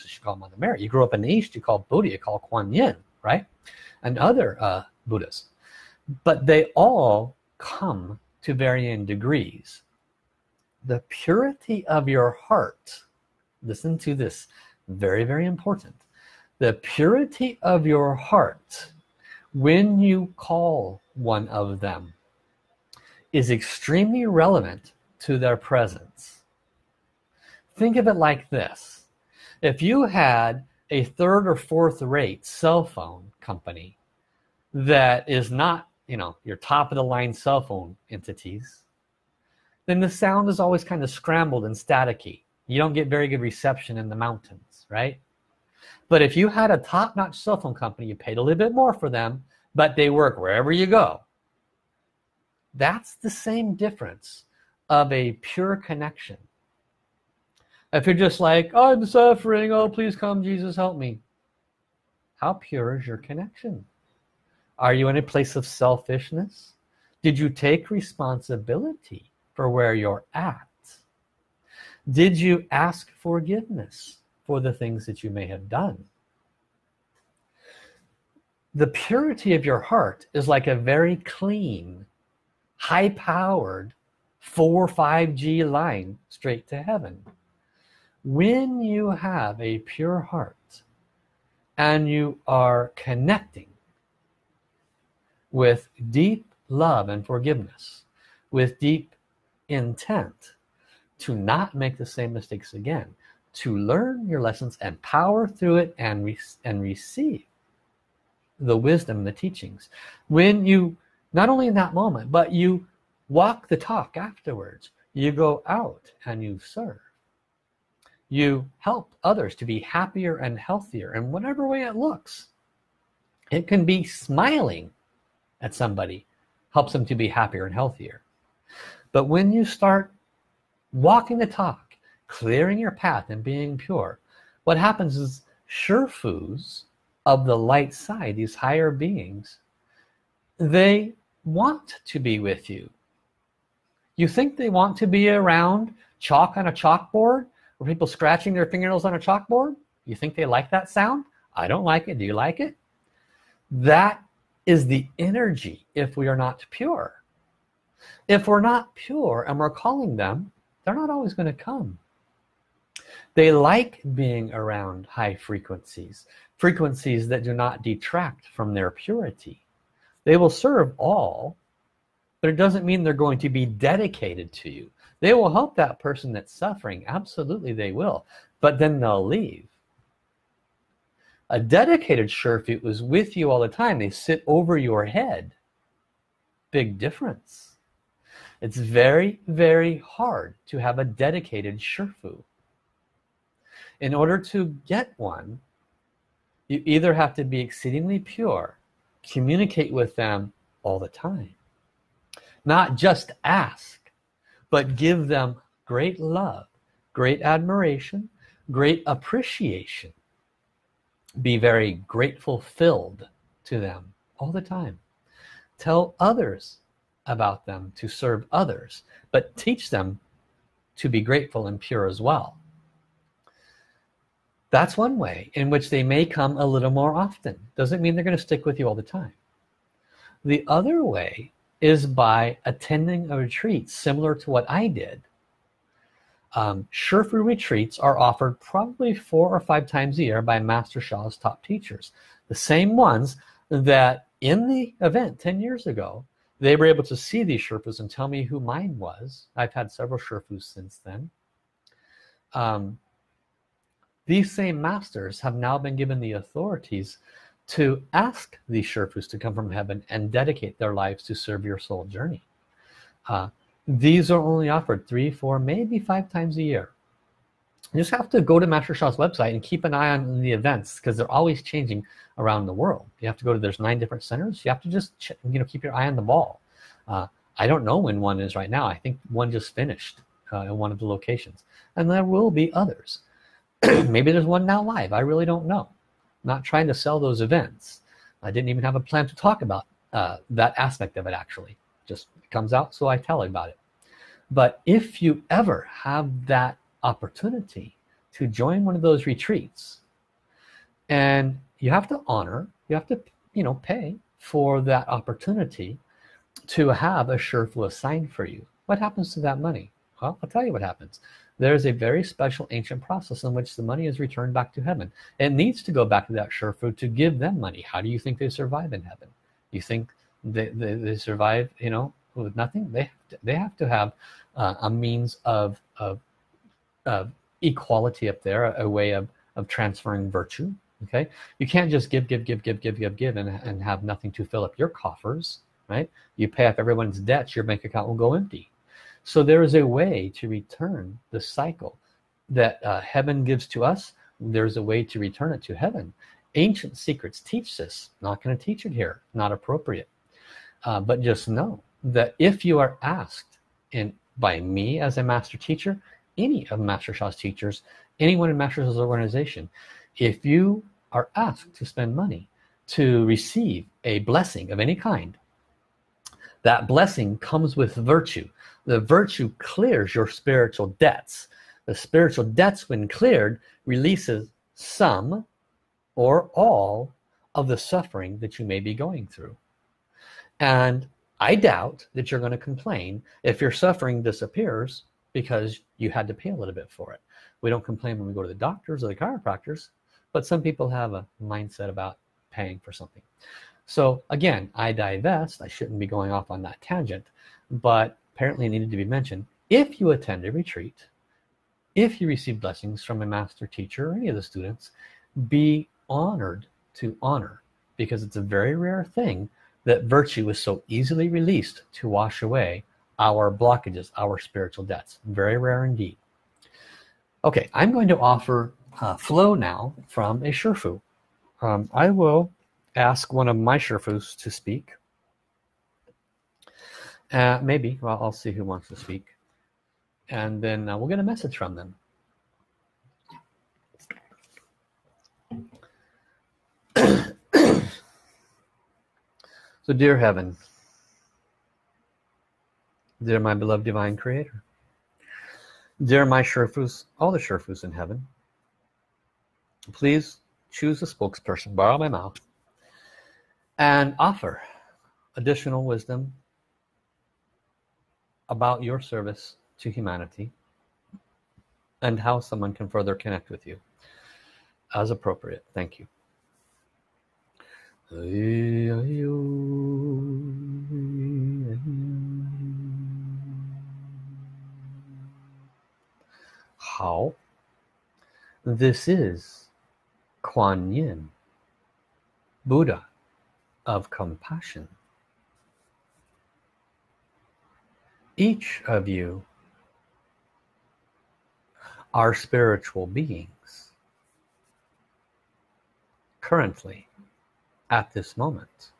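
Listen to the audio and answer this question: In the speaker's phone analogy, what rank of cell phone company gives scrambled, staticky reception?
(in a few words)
third or fourth rate.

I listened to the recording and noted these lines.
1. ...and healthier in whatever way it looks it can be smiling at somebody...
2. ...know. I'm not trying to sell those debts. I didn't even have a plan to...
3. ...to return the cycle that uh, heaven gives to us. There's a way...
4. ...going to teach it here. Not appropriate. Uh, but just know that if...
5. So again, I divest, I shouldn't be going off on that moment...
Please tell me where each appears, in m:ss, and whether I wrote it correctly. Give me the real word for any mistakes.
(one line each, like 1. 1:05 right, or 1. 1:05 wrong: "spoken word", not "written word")
1. 2:00 right
2. 4:45 wrong: "events", not "debts"
3. 5:40 right
4. 5:48 right
5. 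6:33 wrong: "tangent", not "moment".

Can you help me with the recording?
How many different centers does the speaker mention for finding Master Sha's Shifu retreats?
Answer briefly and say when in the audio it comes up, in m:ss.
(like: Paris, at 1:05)
9, at 4:33.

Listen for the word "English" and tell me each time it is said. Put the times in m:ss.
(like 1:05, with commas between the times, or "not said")
not said.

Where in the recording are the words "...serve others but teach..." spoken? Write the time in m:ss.
3:38.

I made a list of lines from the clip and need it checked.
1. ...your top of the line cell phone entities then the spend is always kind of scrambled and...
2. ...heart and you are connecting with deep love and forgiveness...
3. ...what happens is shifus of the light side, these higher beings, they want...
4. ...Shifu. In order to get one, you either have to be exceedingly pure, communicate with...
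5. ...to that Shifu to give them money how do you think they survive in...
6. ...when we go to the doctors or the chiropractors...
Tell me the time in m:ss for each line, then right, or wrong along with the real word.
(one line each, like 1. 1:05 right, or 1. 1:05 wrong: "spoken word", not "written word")
1. 0:36 wrong: "sound", not "spend"
2. 1:30 right
3. 2:14 right
4. 3:11 right
5. 5:16 right
6. 6:28 right.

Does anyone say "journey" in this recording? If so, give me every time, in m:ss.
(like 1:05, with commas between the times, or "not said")
4:22.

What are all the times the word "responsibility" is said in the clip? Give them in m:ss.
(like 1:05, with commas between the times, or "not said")
1:07.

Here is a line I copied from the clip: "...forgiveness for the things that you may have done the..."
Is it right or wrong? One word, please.
right.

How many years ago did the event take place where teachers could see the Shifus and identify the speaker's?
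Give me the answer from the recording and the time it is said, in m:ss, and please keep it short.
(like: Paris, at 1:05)
10, at 4:05.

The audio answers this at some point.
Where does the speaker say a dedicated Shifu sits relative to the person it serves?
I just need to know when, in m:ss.
3:04.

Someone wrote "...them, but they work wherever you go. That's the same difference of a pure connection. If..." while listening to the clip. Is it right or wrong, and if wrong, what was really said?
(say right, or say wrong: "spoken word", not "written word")
right.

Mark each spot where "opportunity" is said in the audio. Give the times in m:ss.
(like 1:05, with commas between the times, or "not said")
4:57, 5:05.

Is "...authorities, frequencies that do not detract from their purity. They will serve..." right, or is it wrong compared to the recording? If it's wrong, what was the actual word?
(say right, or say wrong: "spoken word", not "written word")
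wrong: "frequencies", not "authorities".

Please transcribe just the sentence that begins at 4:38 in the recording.
I think one just finished uh, in one of the locations.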